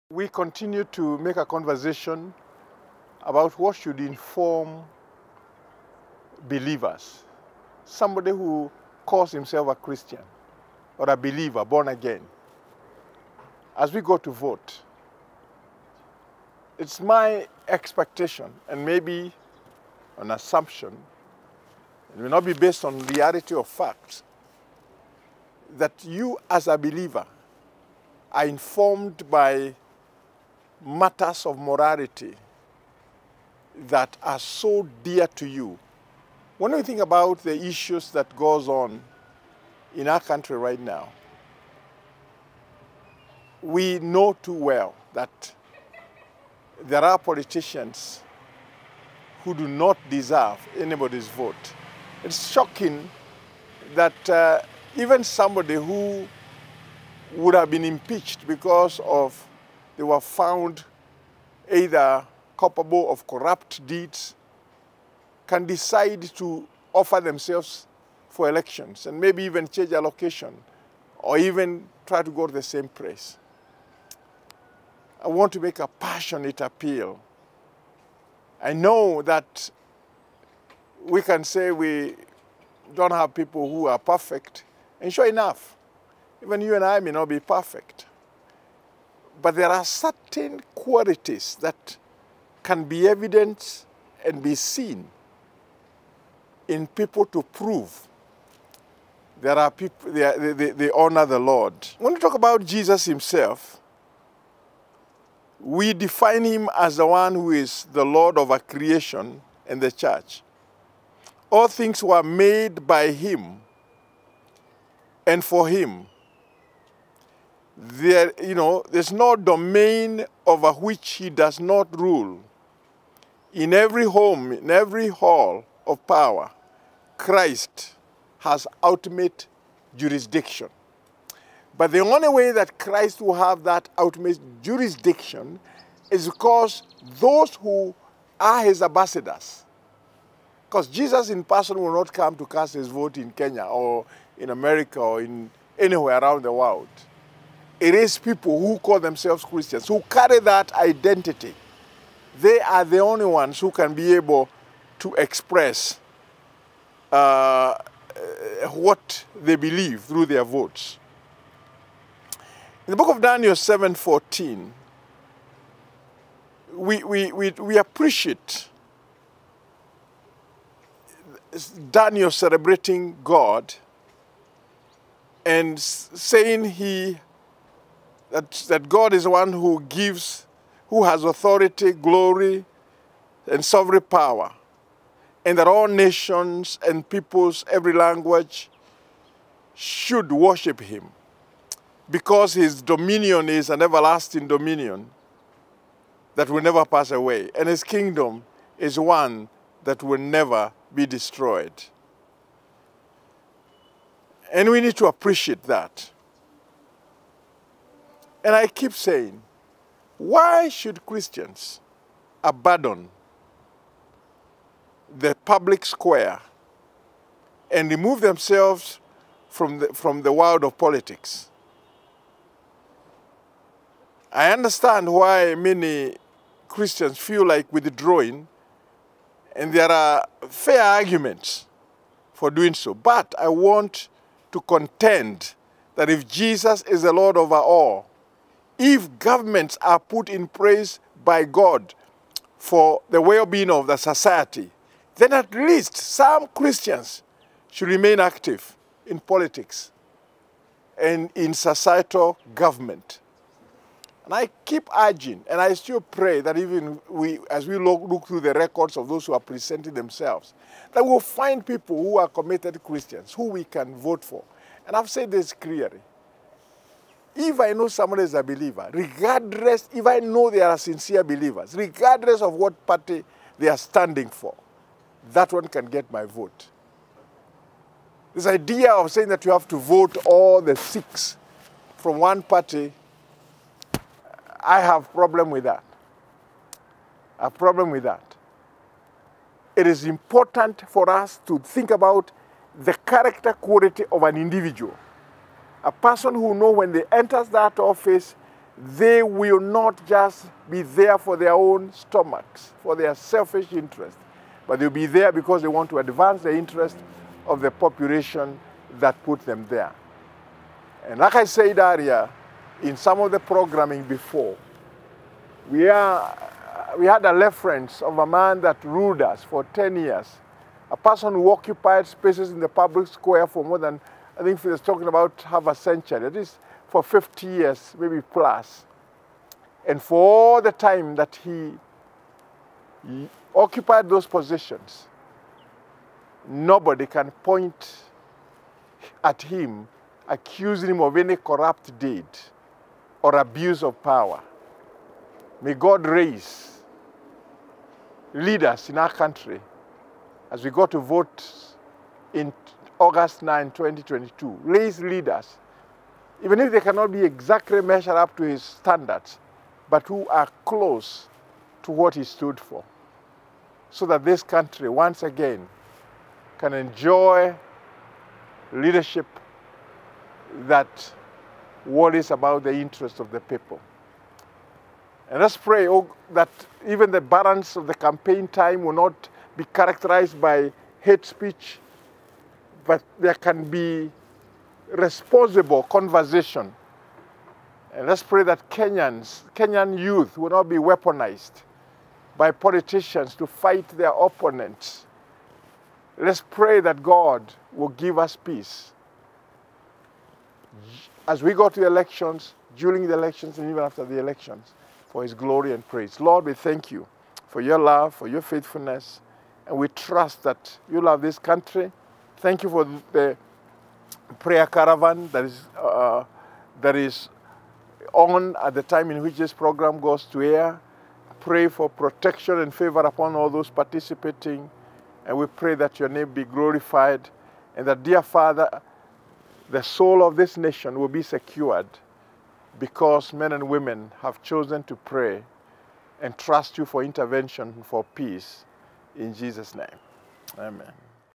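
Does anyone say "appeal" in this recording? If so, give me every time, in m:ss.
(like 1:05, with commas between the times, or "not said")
1:16.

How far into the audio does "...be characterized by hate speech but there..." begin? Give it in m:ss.
6:19.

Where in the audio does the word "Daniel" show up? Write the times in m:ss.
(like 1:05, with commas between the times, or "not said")
2:43, 2:51.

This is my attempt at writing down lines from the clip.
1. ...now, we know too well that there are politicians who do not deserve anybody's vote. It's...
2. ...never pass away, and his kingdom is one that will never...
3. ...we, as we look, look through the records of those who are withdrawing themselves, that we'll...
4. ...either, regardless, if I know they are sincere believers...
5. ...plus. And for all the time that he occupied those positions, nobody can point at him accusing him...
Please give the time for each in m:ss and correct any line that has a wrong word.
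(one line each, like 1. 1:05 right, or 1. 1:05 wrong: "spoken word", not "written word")
1. 0:40 right
2. 3:16 right
3. 4:17 wrong: "presenting", not "withdrawing"
4. 4:28 wrong: "believer", not "either"
5. 5:28 right.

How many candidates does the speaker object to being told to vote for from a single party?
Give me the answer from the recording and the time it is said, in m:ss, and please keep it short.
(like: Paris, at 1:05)
6, at 4:40.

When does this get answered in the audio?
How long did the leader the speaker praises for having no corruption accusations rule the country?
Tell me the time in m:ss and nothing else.
5:19.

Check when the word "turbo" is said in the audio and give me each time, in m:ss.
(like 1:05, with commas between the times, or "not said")
not said.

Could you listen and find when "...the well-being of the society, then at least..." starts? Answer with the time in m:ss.
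4:03.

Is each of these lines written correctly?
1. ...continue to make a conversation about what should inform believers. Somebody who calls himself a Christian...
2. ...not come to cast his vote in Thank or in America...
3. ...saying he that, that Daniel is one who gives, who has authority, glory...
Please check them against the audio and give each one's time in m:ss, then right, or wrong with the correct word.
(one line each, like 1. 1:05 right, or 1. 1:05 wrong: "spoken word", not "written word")
1. 0:00 right
2. 2:21 wrong: "Kenya", not "Thank"
3. 2:55 wrong: "God", not "Daniel".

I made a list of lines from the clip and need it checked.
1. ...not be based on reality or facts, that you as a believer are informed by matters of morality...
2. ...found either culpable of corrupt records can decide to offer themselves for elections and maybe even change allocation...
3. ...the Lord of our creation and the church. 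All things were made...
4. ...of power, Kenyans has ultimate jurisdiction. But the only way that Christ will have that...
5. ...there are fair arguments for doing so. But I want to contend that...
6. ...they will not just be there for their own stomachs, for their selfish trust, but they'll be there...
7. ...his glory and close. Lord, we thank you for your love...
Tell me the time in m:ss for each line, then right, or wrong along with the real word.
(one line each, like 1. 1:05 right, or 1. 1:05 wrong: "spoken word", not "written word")
1. 0:22 right
2. 1:00 wrong: "deeds", not "records"
3. 1:47 right
4. 2:05 wrong: "Christ", not "Kenyans"
5. 3:49 right
6. 4:58 wrong: "interest", not "trust"
7. 6:45 wrong: "praise", not "close".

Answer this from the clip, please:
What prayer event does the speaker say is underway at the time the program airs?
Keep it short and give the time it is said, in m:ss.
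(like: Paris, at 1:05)
prayer caravan, at 6:54.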